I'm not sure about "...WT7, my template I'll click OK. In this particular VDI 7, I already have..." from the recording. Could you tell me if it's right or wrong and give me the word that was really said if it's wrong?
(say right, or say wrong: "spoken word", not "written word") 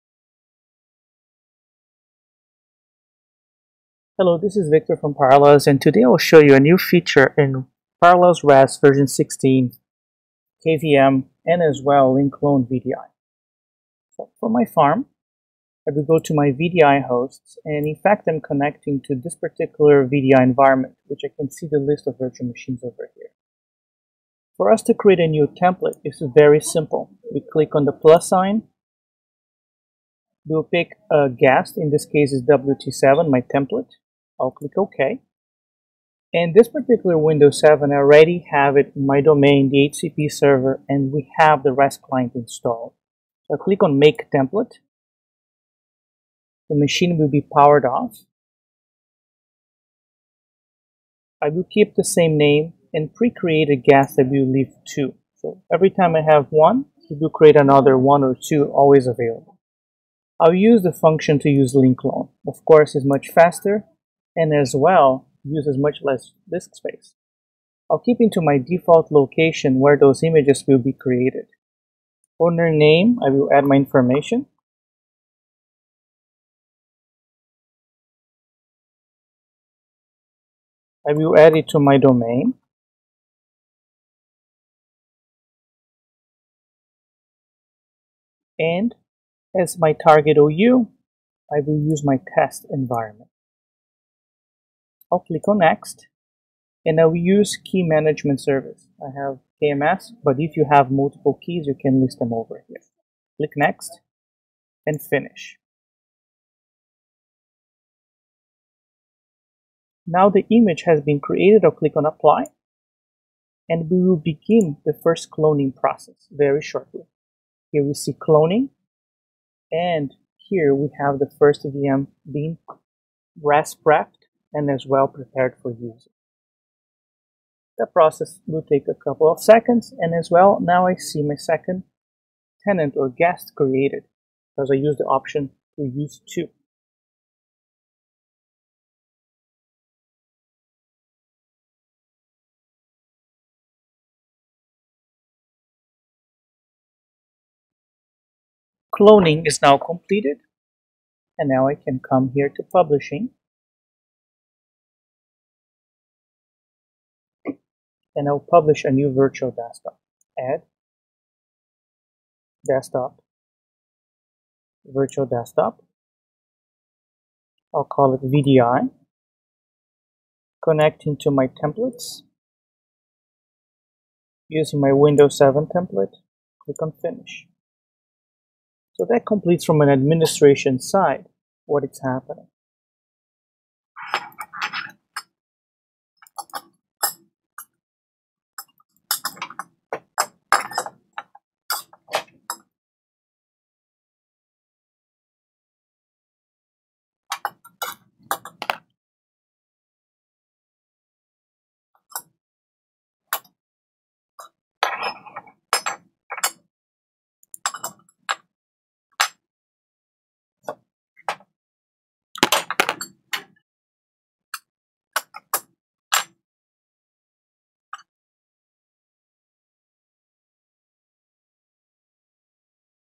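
wrong: "Windows", not "VDI".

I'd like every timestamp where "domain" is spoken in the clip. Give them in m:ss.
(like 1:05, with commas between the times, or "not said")
0:39, 1:21.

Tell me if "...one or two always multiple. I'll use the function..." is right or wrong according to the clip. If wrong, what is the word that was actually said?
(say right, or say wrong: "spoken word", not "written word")
wrong: "available", not "multiple".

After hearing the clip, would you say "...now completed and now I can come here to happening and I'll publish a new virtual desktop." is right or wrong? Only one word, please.
wrong.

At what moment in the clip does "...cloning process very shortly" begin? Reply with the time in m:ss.
1:55.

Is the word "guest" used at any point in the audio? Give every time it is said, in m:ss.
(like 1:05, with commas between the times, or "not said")
0:31, 0:53, 2:13.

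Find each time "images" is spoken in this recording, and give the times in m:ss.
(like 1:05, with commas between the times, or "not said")
1:10, 1:50.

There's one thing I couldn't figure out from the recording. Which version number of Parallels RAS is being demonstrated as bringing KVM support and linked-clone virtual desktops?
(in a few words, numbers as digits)
16.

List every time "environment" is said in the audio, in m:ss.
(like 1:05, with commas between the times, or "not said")
0:20, 1:32.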